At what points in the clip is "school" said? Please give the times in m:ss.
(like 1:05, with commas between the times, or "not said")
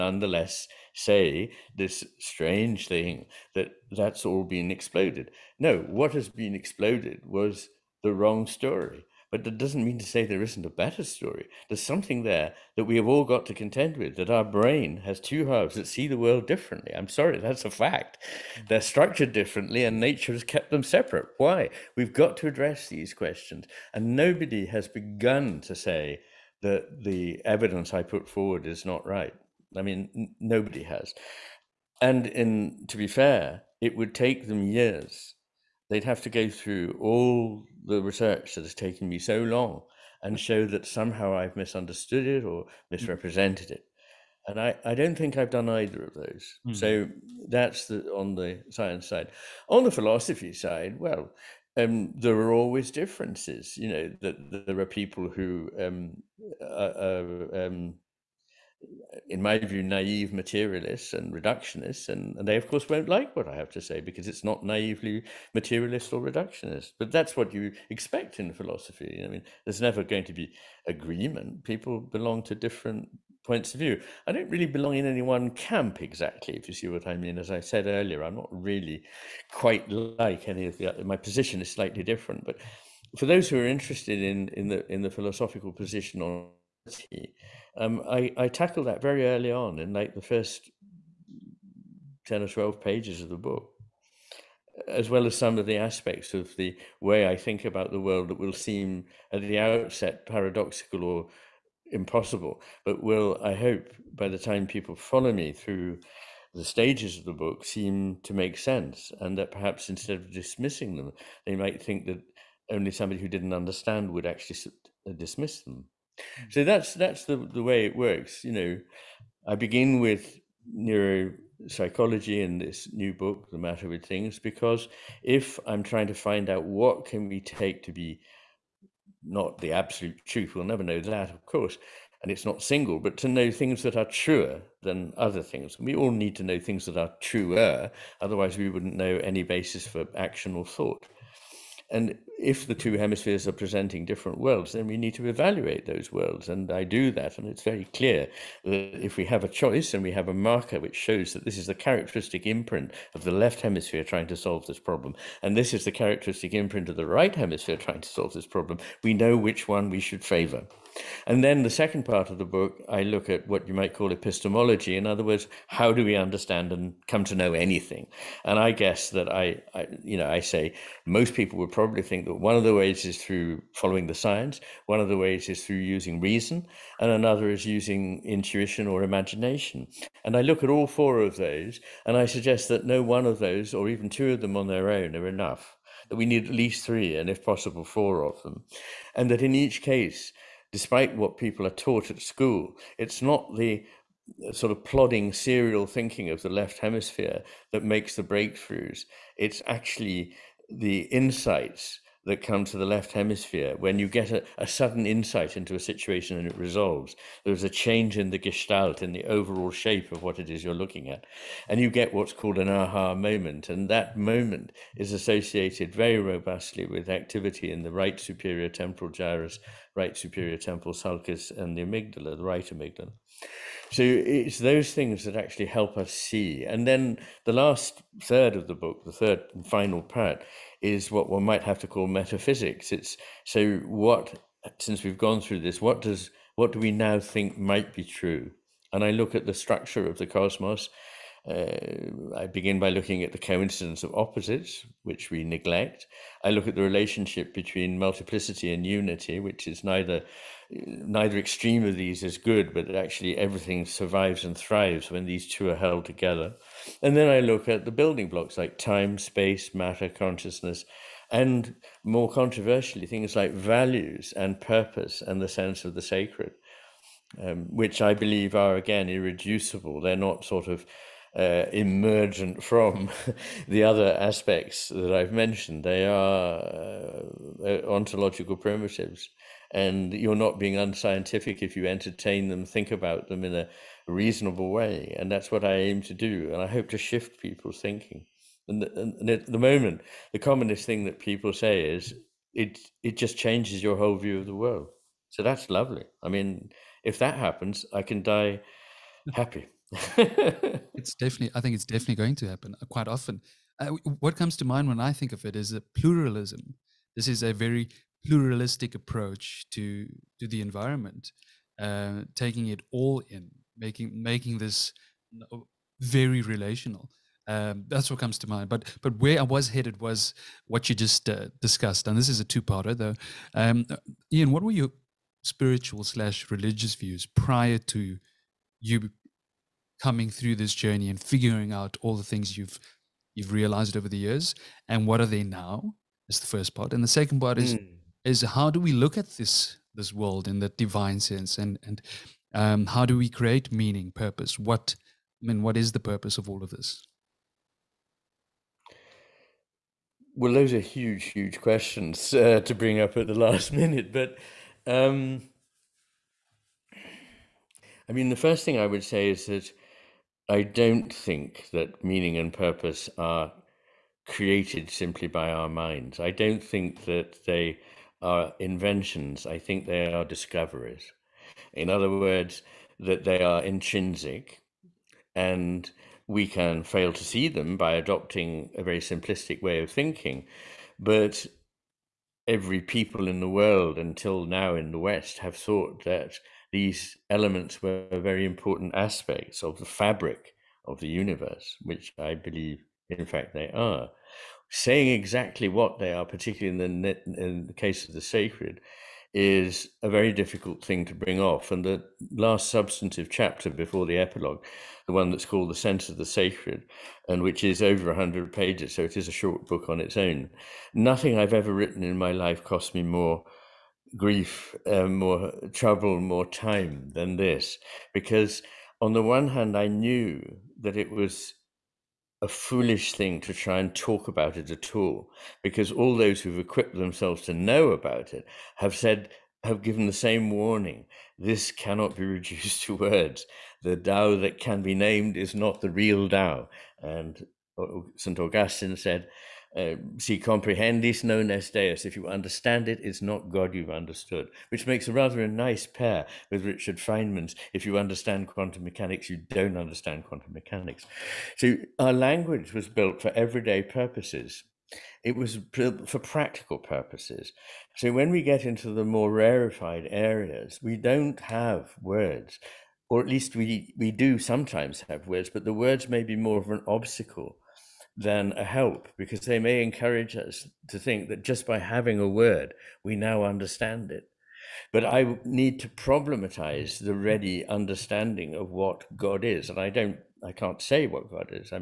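3:12.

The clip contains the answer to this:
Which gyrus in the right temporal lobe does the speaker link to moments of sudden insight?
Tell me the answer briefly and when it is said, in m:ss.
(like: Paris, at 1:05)
right superior temporal gyrus, at 3:37.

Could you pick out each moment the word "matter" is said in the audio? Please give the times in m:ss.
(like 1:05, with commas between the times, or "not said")
2:03, 4:19.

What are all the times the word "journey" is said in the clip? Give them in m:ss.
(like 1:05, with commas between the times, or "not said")
5:30.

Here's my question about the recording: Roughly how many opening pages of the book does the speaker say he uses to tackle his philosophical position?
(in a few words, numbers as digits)
10 or 12.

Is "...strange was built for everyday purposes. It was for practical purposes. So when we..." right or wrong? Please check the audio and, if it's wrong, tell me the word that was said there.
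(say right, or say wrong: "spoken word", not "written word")
wrong: "language", not "strange".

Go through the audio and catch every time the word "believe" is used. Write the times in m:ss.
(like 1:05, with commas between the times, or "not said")
4:28, 6:32.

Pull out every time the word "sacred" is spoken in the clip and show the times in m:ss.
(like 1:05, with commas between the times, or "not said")
4:26, 6:38, 6:46.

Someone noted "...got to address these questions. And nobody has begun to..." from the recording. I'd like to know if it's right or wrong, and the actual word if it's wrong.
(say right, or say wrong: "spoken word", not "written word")
right.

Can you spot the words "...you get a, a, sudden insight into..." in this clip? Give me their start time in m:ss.
3:23.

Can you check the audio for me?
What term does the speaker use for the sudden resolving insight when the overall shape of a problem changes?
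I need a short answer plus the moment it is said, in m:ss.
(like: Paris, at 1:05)
aha moment, at 3:32.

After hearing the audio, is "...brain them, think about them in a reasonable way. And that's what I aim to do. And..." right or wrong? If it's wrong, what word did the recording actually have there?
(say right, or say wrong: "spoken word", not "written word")
wrong: "entertain", not "brain".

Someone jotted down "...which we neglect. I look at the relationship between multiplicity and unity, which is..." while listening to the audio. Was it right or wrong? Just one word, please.
right.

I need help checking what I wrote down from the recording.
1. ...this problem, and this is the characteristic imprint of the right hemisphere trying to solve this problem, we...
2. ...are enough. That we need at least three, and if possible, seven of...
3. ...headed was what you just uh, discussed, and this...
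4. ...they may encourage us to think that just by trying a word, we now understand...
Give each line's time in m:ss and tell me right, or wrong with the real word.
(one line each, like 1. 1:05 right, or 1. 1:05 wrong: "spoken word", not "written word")
1. 2:34 right
2. 3:05 wrong: "four", not "seven"
3. 5:19 right
4. 7:49 wrong: "having", not "trying".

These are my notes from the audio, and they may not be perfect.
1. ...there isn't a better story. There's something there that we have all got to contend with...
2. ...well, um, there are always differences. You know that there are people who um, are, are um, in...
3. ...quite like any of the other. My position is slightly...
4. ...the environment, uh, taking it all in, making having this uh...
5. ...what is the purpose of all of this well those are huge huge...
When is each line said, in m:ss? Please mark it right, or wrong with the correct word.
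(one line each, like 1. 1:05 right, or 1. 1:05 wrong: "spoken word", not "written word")
1. 0:10 right
2. 0:50 right
3. 1:19 right
4. 5:10 wrong: "making", not "having"
5. 5:45 right.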